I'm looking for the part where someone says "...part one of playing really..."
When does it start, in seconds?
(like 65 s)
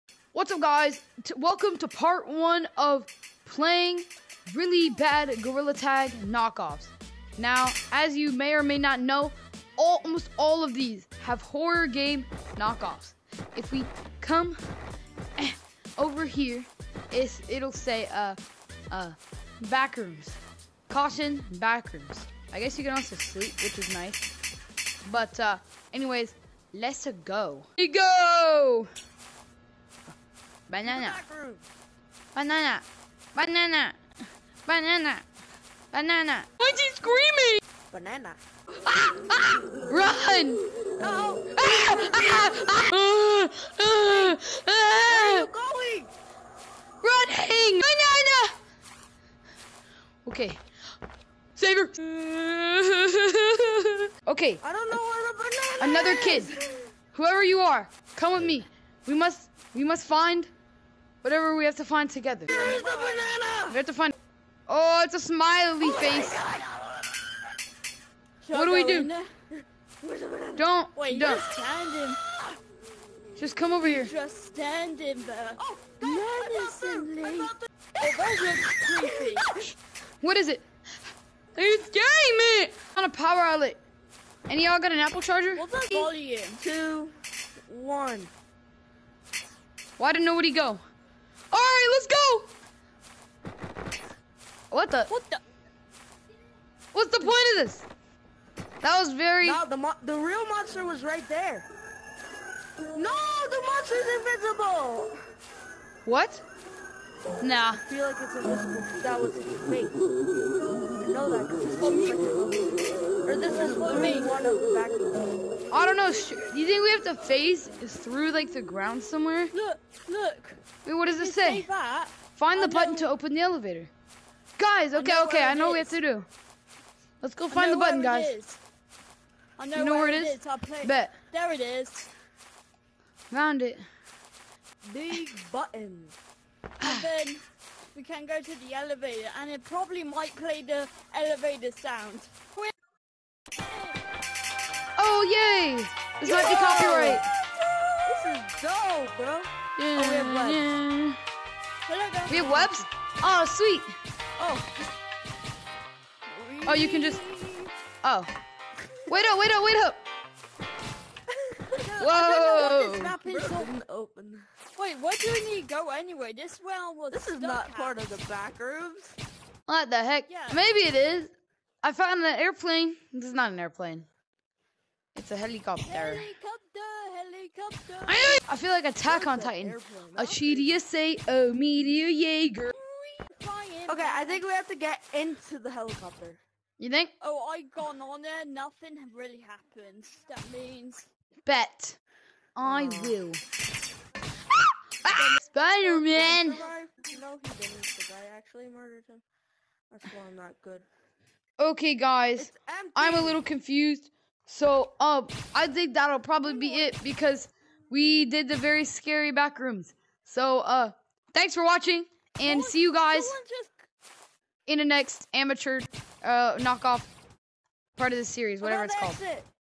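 1 s.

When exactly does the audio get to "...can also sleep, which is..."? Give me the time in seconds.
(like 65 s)
22 s.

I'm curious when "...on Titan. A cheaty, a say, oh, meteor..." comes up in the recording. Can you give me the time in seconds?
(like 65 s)
179 s.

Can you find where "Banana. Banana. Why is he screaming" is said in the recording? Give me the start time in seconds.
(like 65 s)
34 s.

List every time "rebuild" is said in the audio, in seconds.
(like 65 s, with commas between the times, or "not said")
not said.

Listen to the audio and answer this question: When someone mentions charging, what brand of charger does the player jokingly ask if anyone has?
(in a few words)
Apple.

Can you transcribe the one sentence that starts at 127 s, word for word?
Let's go find the button, guys.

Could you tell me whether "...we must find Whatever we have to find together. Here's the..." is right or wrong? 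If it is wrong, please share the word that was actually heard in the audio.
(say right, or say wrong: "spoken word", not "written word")
right.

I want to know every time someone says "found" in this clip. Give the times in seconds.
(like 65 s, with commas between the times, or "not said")
133 s, 171 s.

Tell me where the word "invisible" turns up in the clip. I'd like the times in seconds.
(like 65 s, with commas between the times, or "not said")
104 s, 108 s.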